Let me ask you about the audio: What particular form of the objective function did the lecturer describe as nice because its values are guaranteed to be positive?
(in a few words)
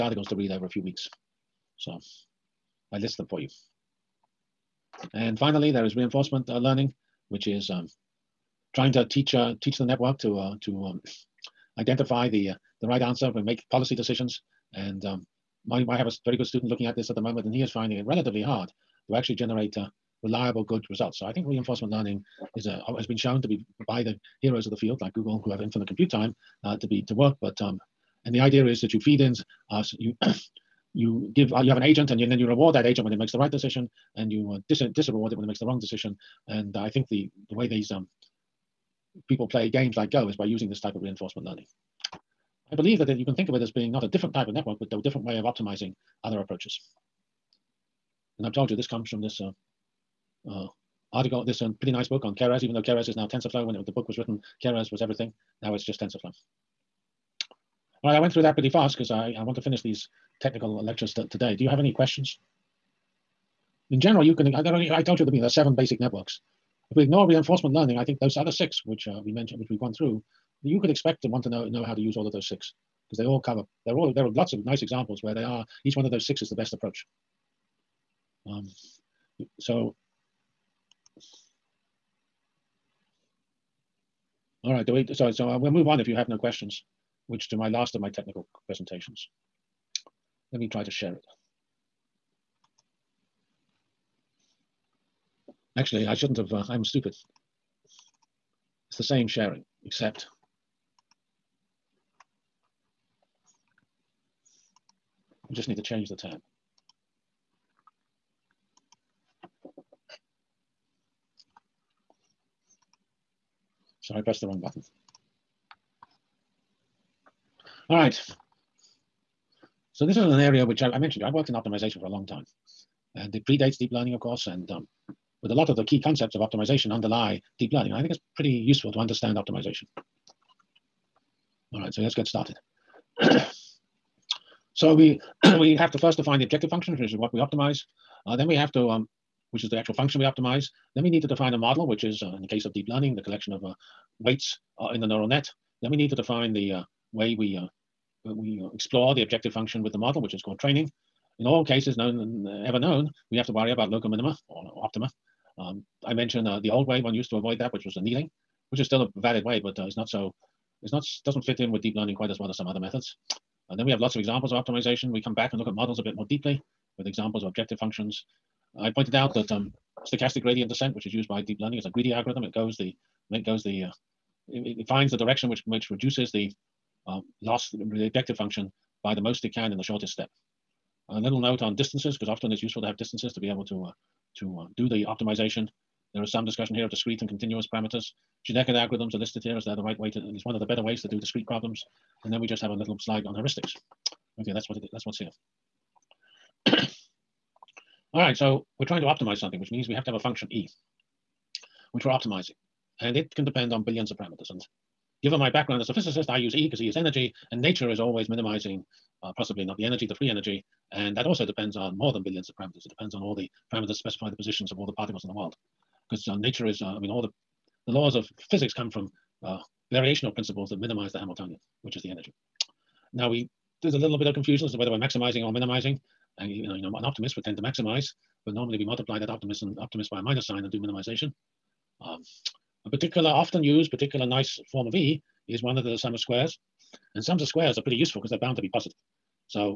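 sum of squares.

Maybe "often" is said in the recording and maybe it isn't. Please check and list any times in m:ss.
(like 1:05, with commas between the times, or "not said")
3:02, 3:53.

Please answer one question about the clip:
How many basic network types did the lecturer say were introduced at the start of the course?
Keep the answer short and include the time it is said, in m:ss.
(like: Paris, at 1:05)
7, at 1:05.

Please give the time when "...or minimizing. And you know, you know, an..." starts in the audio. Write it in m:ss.
3:45.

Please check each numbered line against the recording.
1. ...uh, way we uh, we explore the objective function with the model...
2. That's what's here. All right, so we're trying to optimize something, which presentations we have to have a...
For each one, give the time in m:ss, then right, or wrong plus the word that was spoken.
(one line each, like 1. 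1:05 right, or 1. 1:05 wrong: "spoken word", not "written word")
1. 2:26 right
2. 3:14 wrong: "means", not "presentations".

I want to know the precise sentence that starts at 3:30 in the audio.
And that also depends on more than billions of parameters.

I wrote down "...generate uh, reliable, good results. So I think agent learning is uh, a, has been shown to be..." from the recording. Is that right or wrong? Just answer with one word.
wrong.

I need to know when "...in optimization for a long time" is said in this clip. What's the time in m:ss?
2:01.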